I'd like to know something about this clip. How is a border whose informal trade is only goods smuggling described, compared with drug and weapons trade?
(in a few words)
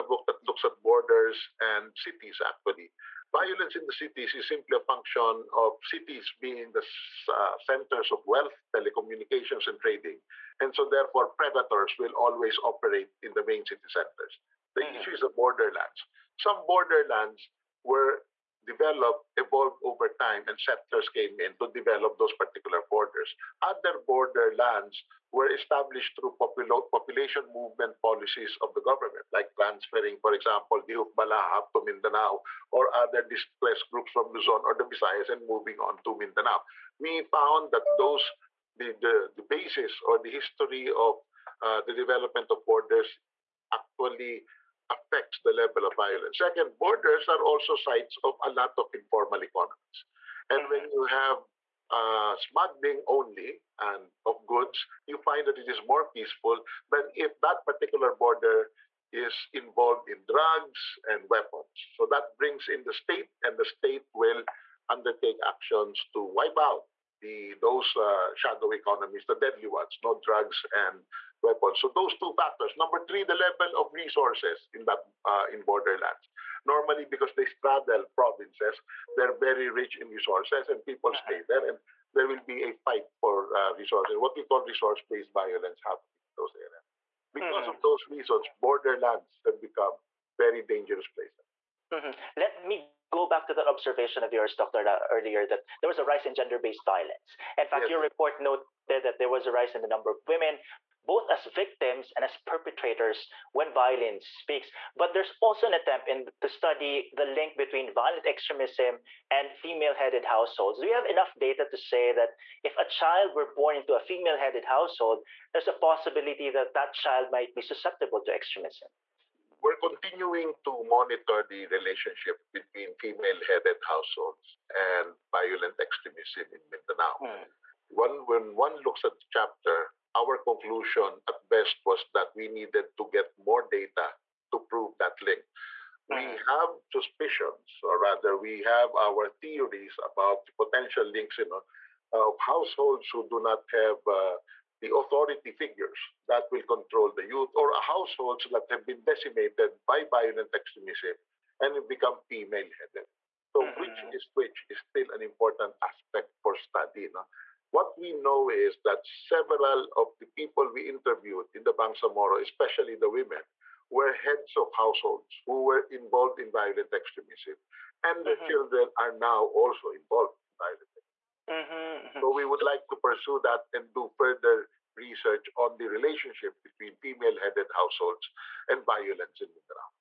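More peaceful.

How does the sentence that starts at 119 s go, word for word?
we're continuing to monitor the relationship between female-headed households and violent extremism in Mindanao.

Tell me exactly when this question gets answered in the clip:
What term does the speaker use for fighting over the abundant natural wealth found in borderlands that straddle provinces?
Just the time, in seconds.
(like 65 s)
84 s.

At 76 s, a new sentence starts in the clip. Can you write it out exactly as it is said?
Normally, because they straddle provinces, they're very rich in resources, and people mm-hmm.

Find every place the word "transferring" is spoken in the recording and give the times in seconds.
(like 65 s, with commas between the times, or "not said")
29 s.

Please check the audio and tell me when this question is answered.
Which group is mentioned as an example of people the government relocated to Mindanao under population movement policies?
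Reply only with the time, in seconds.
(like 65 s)
30 s.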